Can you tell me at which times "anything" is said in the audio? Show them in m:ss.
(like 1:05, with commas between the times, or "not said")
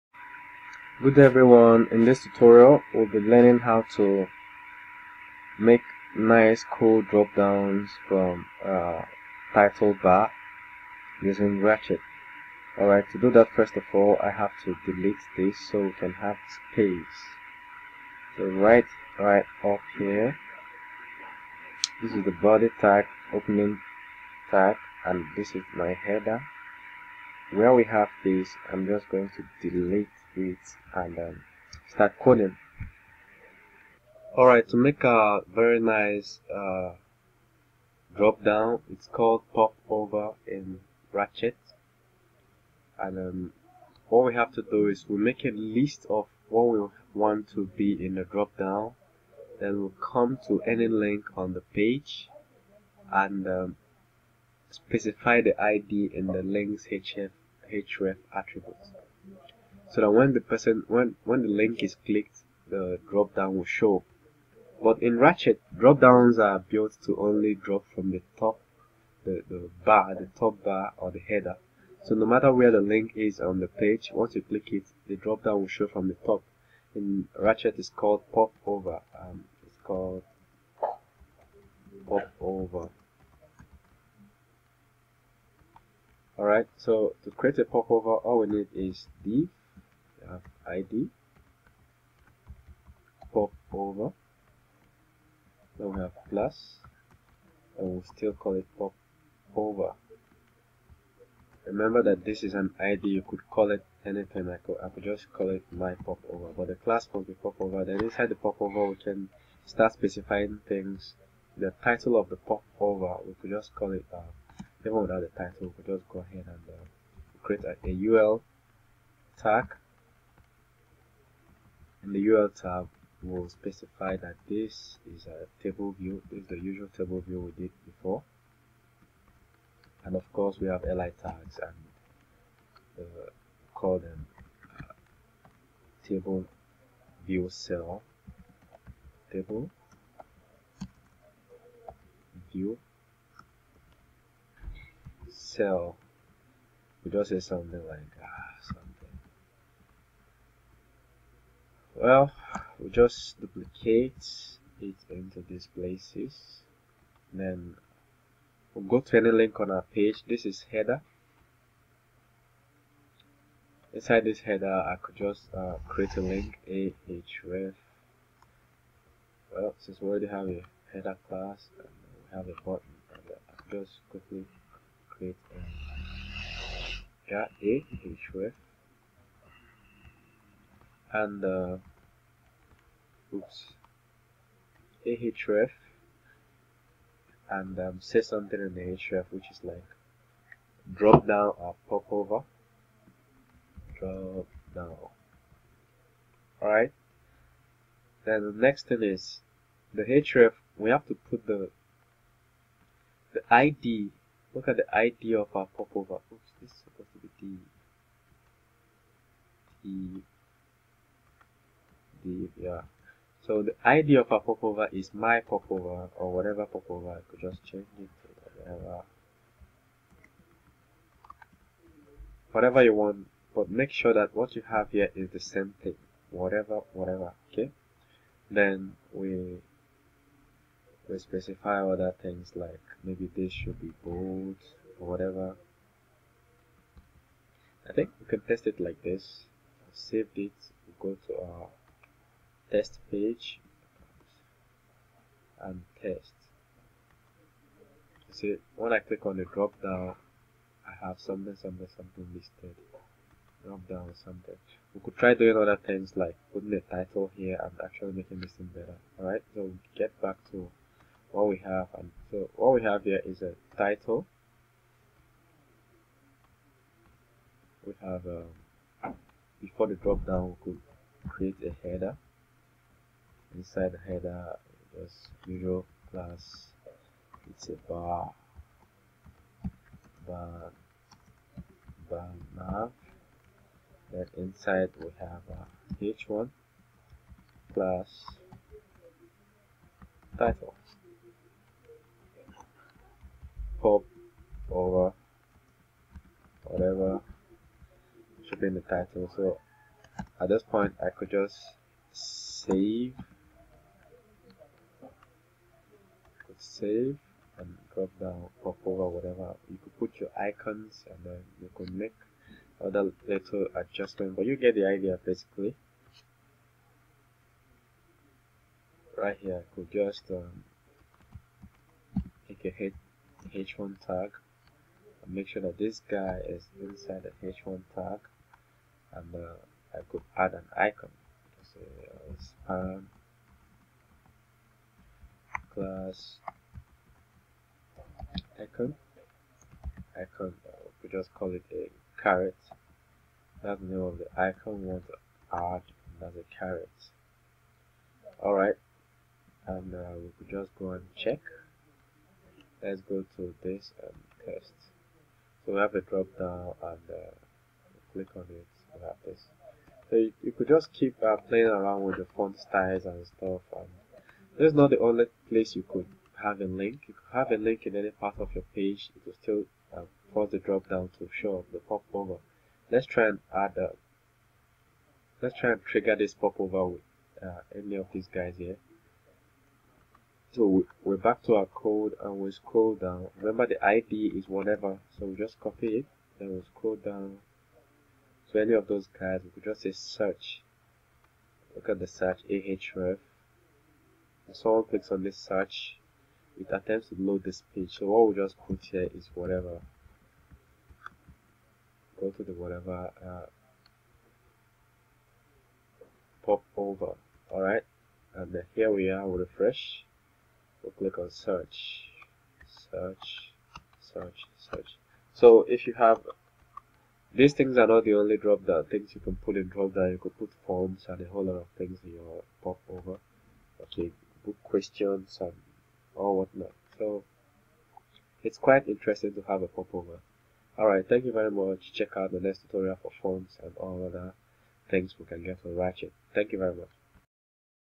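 1:44.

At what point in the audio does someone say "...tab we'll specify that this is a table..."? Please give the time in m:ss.
2:02.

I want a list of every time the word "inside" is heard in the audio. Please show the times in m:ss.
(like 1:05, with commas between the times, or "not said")
1:48, 2:43, 4:33, 4:44, 5:26.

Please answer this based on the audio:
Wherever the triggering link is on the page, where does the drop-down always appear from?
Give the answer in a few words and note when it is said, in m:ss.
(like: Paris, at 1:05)
the top bar, at 1:10.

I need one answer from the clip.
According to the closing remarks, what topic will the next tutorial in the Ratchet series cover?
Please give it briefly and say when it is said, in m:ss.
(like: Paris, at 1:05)
fonts, at 7:13.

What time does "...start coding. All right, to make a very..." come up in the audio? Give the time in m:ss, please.
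0:31.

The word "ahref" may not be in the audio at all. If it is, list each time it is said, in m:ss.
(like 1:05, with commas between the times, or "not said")
2:46, 2:57, 3:05, 6:32.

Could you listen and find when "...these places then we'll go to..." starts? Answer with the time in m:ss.
2:35.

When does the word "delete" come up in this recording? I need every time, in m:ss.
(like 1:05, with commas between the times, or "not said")
0:14, 0:29.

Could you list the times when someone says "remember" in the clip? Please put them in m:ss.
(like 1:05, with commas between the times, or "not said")
1:41, 6:23.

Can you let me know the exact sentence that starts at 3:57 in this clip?
I think we can test it like this.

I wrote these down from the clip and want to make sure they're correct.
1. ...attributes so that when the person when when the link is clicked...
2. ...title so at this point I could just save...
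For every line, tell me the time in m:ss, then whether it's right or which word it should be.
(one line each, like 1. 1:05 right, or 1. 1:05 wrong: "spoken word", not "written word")
1. 0:58 right
2. 4:58 right.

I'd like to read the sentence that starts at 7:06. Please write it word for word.
So it's quite interesting to have a pop over.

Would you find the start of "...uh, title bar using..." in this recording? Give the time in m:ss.
0:08.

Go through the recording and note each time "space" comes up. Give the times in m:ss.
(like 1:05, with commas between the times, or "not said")
0:16.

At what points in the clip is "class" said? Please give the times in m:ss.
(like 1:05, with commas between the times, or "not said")
1:46, 2:51, 4:36, 4:47, 5:35.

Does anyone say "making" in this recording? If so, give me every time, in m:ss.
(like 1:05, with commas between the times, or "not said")
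4:18.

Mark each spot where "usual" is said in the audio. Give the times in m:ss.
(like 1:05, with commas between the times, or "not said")
2:06, 4:35.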